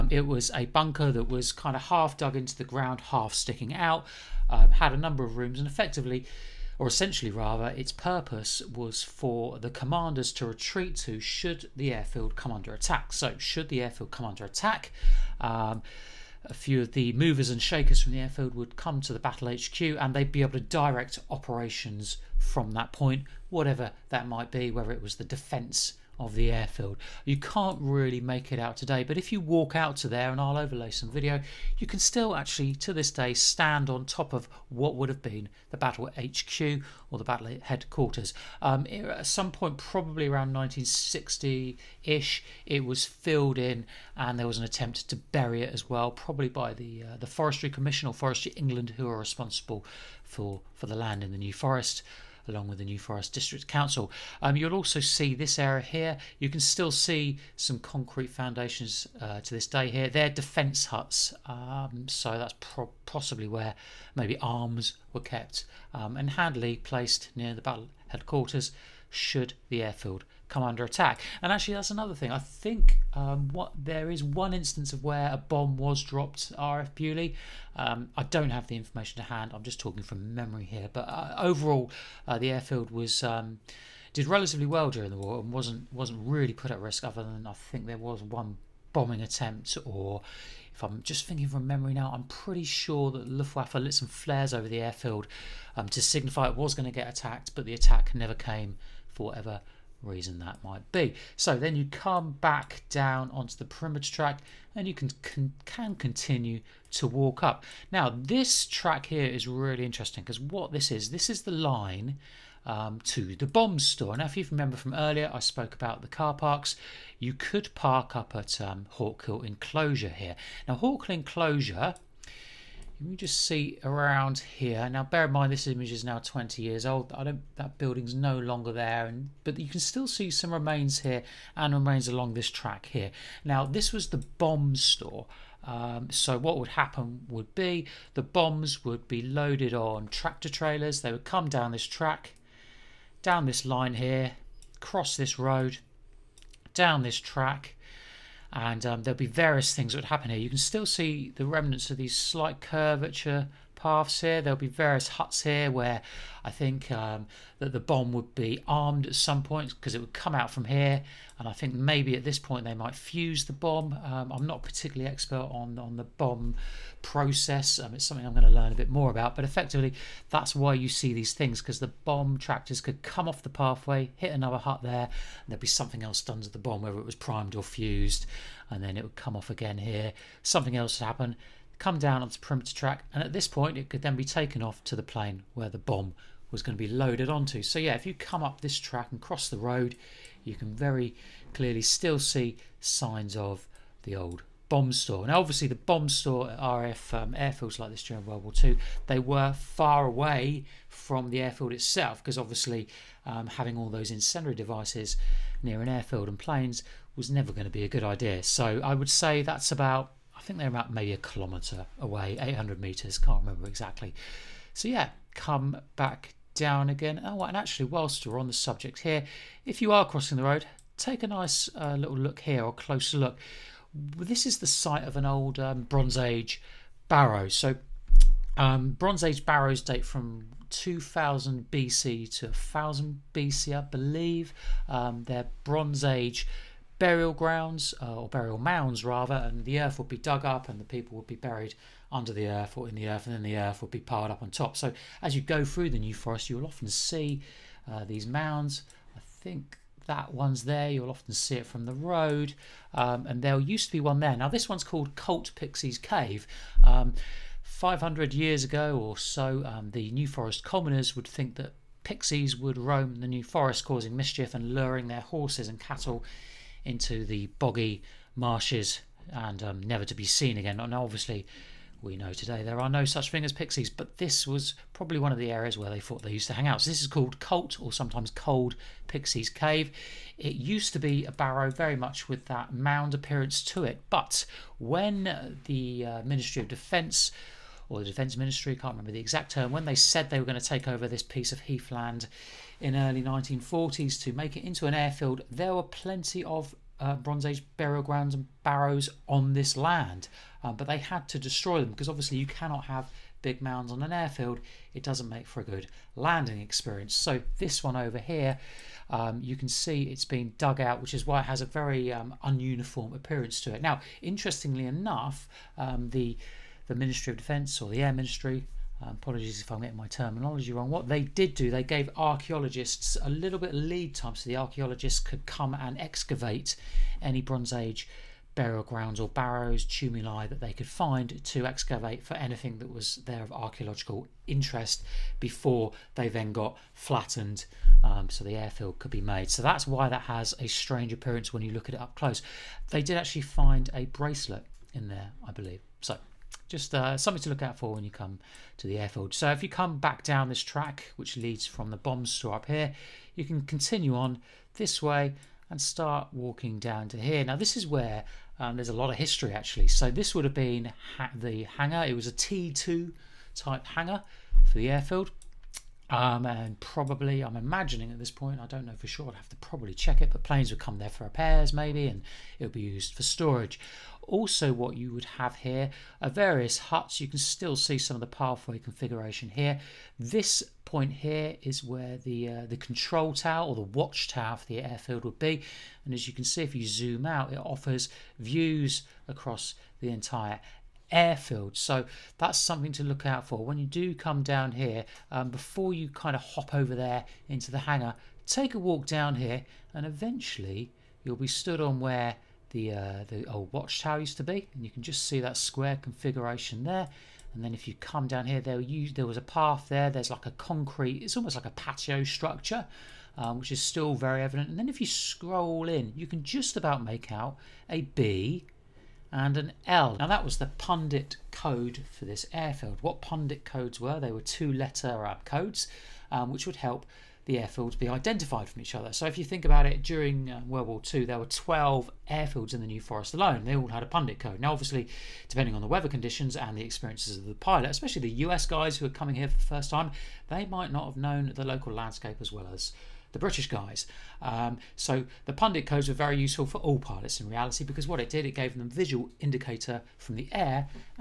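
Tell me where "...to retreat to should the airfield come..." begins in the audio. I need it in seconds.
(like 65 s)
10 s.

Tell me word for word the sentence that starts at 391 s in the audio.
So that's something to look out for.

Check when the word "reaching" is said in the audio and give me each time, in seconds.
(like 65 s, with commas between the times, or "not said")
not said.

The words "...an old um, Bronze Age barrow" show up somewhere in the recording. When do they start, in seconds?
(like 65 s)
225 s.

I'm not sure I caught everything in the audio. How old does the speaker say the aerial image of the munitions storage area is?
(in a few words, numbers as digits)
20 years.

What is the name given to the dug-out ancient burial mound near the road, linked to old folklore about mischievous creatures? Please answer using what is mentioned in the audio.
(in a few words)
Colt Pixie's Cave.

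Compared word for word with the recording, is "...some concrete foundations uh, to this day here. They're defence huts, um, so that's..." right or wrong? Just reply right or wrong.
right.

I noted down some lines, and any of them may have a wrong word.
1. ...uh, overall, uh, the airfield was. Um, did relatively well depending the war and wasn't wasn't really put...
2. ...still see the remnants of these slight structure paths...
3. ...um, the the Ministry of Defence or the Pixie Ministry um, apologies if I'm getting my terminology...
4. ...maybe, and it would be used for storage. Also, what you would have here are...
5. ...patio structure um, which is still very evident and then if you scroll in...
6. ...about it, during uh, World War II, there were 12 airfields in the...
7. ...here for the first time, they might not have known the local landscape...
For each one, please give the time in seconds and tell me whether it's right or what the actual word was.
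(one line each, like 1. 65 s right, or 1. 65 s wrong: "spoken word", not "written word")
1. 81 s wrong: "during", not "depending"
2. 150 s wrong: "curvature", not "structure"
3. 315 s wrong: "Air", not "Pixie"
4. 371 s right
5. 411 s right
6. 429 s right
7. 439 s right.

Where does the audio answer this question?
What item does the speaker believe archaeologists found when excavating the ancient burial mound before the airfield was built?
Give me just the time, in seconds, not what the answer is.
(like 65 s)
344 s.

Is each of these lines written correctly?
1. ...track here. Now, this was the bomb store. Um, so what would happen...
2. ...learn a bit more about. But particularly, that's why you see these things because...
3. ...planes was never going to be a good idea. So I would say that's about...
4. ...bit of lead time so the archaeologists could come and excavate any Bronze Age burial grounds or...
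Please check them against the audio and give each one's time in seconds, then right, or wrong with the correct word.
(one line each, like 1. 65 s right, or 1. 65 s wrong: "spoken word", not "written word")
1. 132 s right
2. 168 s wrong: "effectively", not "particularly"
3. 206 s right
4. 323 s right.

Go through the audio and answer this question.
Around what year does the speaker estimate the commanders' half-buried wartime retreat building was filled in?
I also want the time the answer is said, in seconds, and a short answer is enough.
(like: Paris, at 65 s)
1960, at 40 s.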